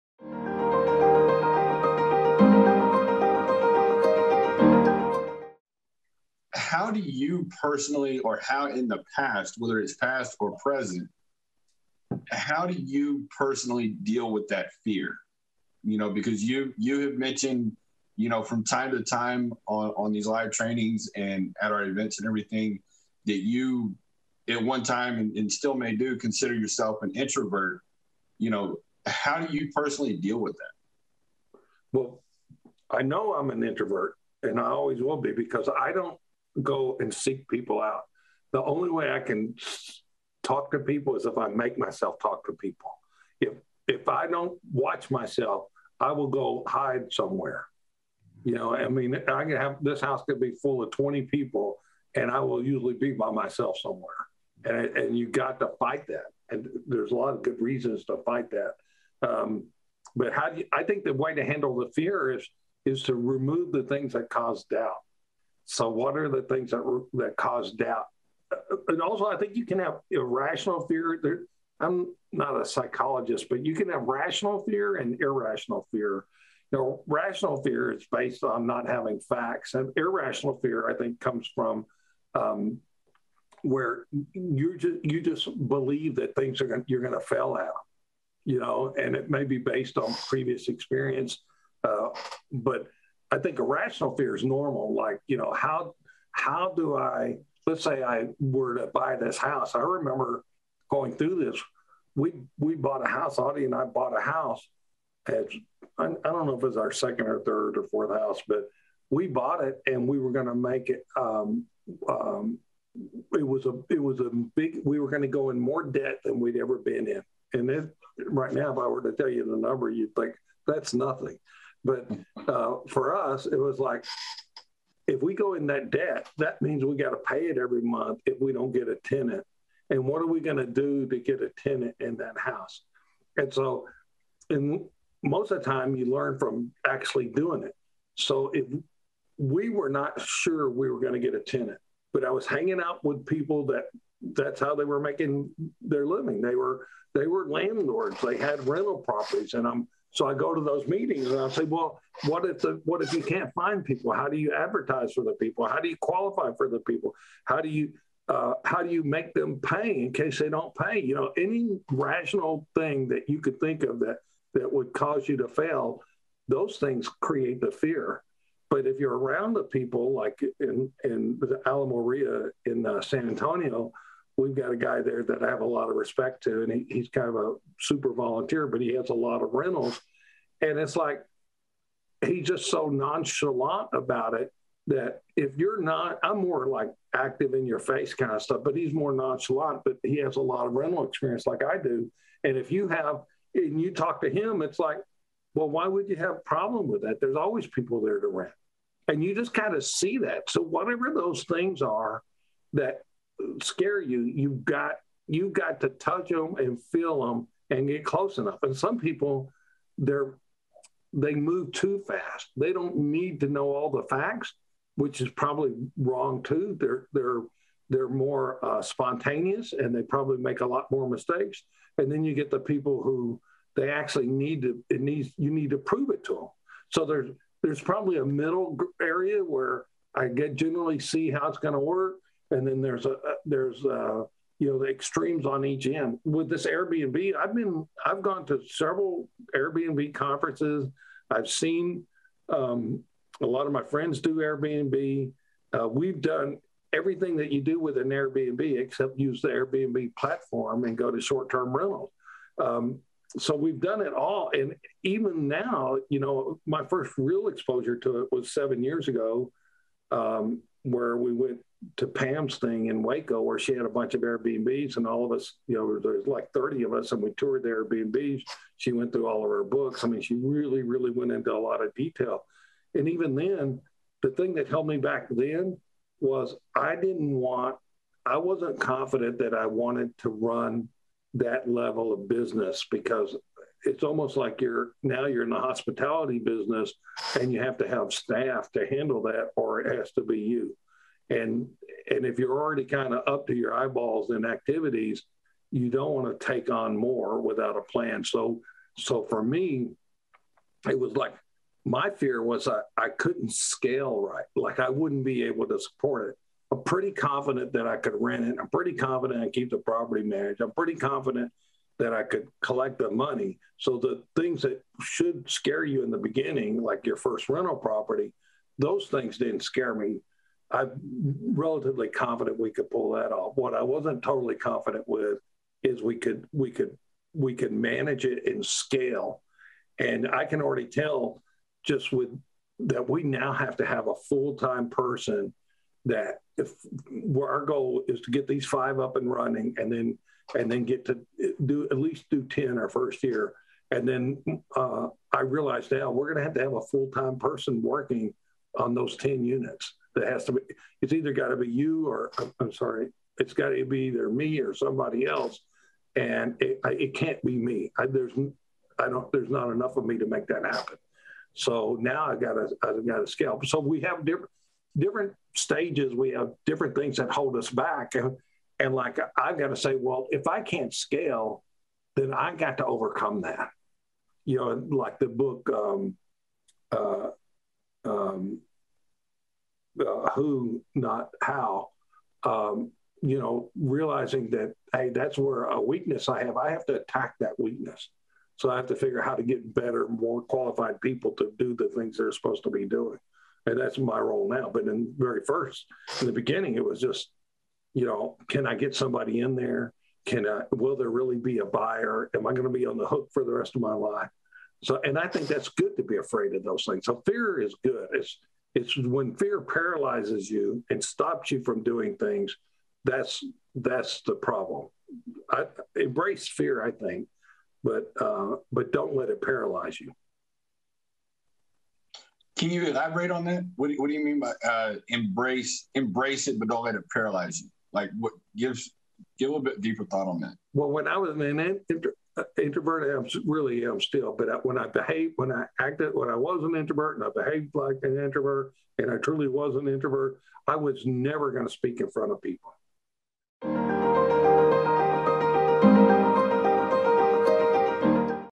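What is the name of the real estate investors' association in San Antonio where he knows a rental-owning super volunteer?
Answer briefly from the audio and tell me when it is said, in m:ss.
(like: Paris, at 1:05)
Alamo REIA, at 2:51.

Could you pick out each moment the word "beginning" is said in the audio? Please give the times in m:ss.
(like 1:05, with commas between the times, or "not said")
5:16, 6:36.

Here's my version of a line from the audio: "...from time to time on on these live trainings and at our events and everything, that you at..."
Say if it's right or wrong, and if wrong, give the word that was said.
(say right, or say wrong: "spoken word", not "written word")
right.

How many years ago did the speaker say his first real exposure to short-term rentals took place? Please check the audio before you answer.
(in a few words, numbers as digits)
7.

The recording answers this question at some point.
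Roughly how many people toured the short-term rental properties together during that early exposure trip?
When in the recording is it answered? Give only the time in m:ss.
4:26.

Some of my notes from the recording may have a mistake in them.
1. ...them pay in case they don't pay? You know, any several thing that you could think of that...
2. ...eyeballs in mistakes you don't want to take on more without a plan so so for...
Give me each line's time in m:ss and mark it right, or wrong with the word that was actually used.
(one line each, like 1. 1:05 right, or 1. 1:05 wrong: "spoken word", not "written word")
1. 2:39 wrong: "rational", not "several"
2. 4:53 wrong: "activities", not "mistakes".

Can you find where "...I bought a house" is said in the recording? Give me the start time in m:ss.
1:43.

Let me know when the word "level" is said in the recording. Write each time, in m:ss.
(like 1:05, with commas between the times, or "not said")
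4:41.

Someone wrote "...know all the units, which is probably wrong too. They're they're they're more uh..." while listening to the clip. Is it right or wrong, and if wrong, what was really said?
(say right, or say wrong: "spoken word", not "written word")
wrong: "facts", not "units".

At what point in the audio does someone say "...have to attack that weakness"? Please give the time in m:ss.
6:26.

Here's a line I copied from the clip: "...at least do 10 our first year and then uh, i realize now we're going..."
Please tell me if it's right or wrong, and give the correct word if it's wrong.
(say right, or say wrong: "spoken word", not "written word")
right.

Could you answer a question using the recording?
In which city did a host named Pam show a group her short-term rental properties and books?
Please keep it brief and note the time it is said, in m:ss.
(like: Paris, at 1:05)
Waco, at 4:23.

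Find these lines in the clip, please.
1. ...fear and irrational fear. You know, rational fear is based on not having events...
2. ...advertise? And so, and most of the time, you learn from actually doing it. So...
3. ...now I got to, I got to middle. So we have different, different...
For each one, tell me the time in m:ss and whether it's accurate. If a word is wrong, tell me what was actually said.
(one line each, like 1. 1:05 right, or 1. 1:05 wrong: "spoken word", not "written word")
1. 1:14 wrong: "facts", not "events"
2. 2:12 wrong: "house", not "advertise"
3. 6:01 wrong: "scale", not "middle".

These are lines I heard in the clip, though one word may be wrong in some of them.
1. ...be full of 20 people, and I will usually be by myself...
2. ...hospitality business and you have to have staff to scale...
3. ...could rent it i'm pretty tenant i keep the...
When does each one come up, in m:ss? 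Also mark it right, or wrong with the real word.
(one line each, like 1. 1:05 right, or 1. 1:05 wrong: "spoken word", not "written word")
1. 0:50 right
2. 4:45 wrong: "handle", not "scale"
3. 5:07 wrong: "confident", not "tenant".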